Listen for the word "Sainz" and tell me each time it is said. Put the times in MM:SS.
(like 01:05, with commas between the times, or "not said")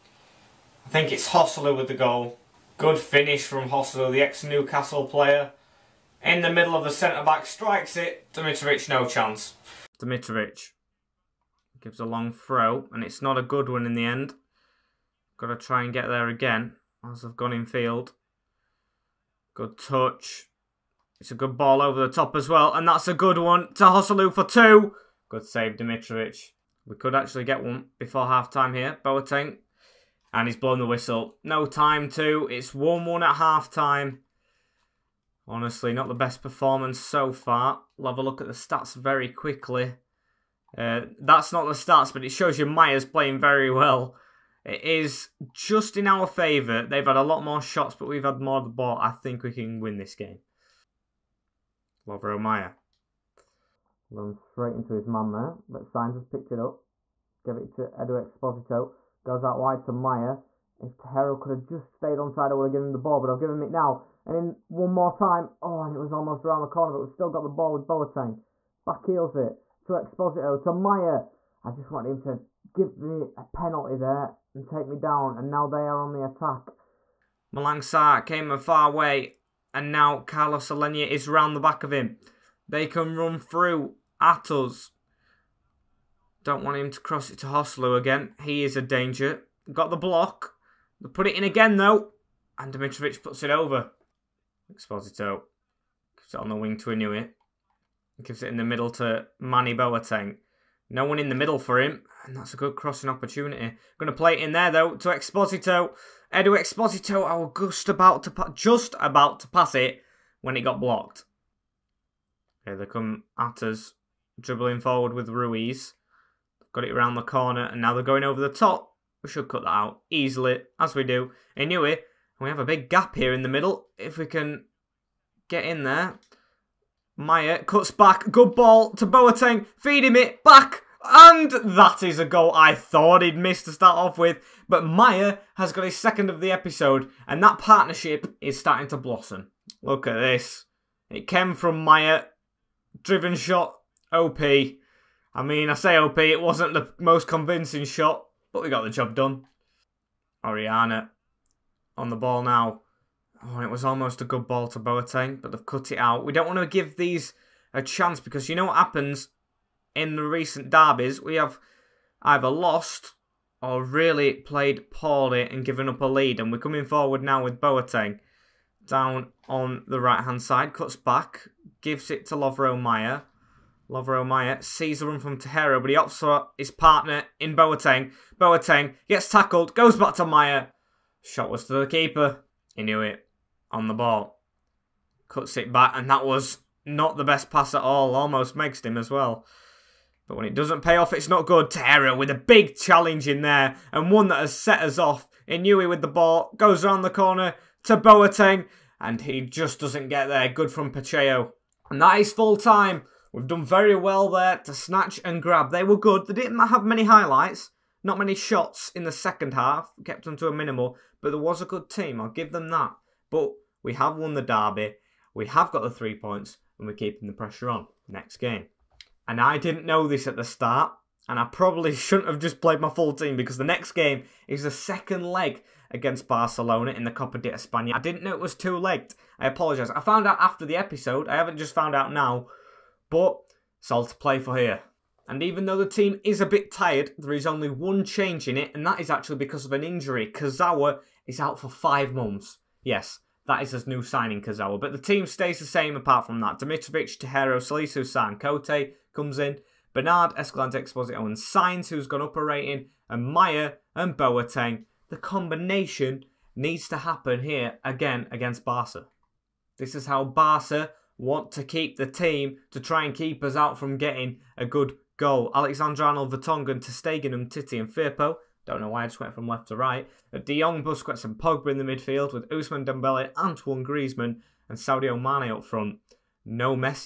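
00:55, 04:11.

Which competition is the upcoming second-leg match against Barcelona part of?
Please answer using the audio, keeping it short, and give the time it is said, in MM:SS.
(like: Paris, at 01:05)
Copa de España, at 03:47.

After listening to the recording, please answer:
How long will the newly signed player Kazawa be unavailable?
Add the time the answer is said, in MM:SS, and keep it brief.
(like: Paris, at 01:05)
5 months, at 04:01.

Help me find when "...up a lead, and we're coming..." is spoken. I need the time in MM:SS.
02:45.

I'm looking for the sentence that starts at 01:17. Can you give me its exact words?
Malang Sarr came a far way, and now Carlos Aleñá is round the back of him.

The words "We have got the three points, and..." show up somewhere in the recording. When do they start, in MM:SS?
03:35.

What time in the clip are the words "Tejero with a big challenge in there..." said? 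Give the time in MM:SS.
03:11.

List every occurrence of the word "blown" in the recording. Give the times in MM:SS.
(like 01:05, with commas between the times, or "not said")
00:30.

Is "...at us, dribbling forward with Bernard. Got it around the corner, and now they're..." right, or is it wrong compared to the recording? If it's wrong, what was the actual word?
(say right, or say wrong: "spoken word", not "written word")
wrong: "Ruiz", not "Bernard".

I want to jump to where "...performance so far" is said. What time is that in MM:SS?
00:36.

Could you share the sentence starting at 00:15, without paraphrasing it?
Got to try and get there again, as I've gone in field.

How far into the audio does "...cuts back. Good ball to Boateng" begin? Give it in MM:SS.
02:07.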